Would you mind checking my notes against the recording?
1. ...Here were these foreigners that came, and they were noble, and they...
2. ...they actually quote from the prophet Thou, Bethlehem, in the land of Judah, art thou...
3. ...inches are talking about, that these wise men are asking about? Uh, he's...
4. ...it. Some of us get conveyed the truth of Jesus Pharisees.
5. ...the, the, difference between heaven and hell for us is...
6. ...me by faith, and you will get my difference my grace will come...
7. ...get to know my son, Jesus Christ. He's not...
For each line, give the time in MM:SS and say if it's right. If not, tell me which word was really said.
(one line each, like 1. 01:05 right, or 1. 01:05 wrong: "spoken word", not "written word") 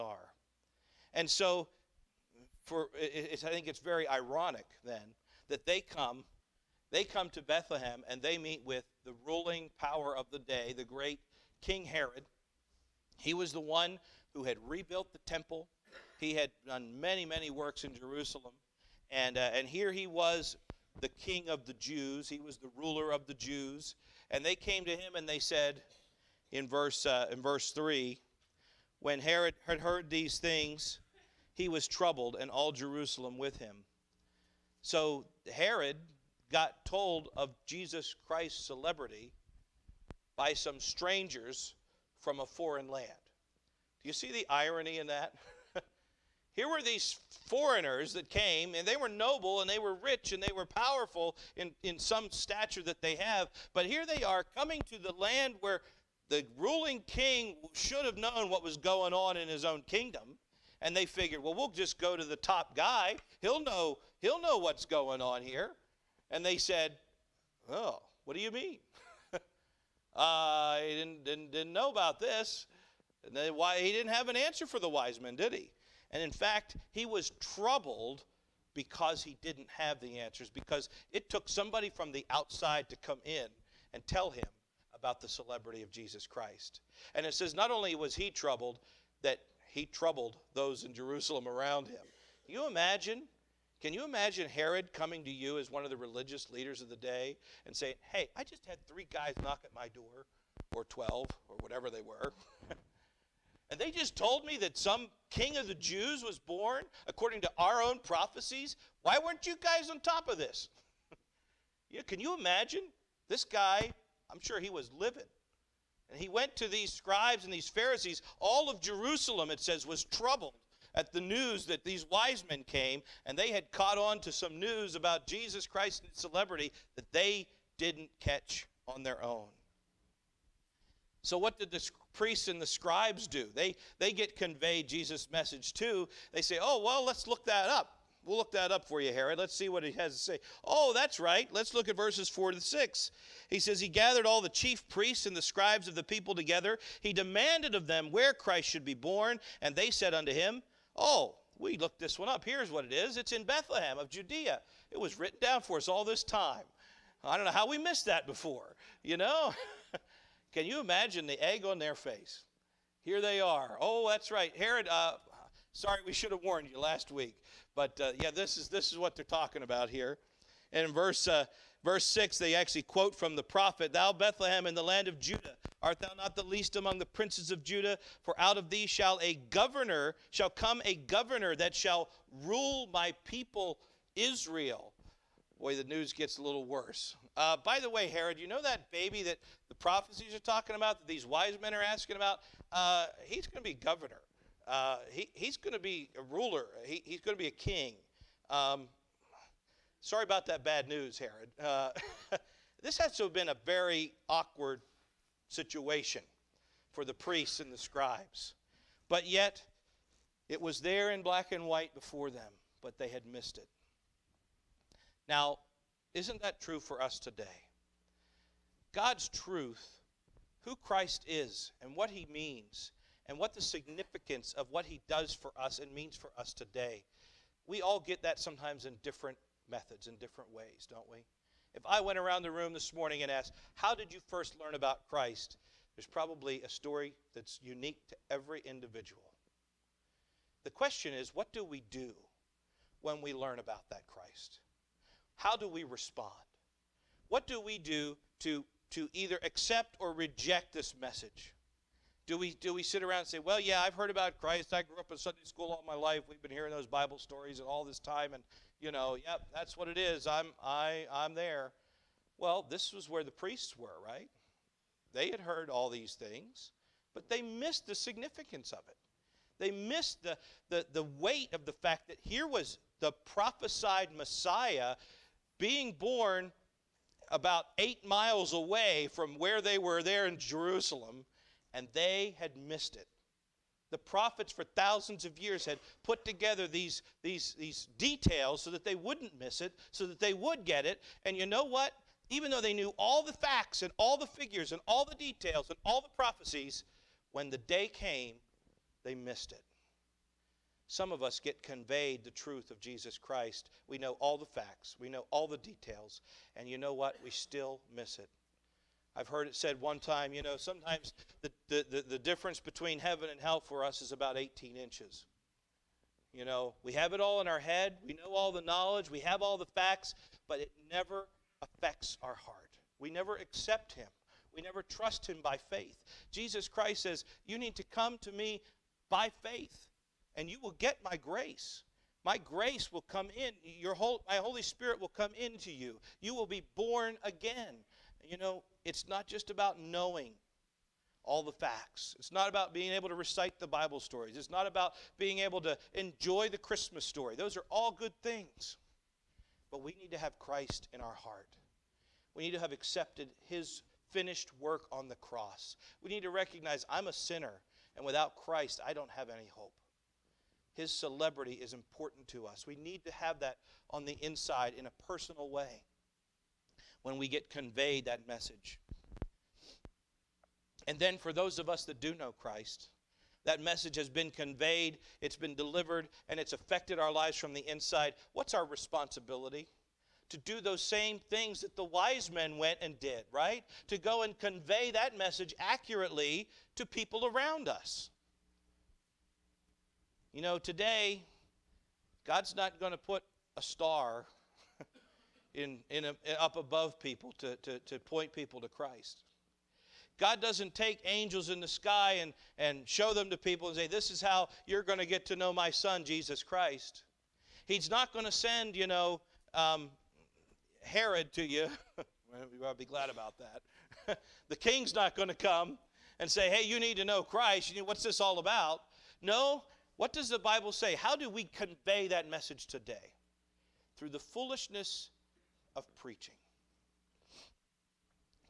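1. 00:46 right
2. 02:52 right
3. 03:09 wrong: "prophecies", not "inches"
4. 04:59 wrong: "Christ", not "Pharisees"
5. 05:11 right
6. 05:28 wrong: "grace", not "difference"
7. 06:45 right.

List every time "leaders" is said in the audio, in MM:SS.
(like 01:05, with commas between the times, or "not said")
01:36.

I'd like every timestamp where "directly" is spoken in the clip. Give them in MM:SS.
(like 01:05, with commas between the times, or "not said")
not said.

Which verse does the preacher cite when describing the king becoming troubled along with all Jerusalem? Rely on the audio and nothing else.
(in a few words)
Verse 3.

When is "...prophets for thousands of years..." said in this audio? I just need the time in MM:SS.
04:43.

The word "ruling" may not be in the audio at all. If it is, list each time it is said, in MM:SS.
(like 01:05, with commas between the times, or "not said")
00:09, 00:56.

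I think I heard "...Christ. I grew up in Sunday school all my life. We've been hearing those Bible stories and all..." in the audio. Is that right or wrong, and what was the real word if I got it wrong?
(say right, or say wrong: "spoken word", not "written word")
right.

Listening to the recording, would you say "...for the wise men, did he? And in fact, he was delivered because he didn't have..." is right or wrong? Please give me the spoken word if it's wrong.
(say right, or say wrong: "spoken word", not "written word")
wrong: "troubled", not "delivered".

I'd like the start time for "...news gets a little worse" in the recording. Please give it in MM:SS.
03:05.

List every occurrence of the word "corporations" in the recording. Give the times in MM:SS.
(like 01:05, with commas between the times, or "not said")
not said.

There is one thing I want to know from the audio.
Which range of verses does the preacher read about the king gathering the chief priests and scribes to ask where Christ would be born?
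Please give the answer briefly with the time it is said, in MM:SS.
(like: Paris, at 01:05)
Verses 4 to 6, at 02:21.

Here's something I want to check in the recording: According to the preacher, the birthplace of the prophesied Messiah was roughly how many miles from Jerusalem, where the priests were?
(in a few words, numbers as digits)
8.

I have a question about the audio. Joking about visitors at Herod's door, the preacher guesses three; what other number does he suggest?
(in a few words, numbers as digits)
12.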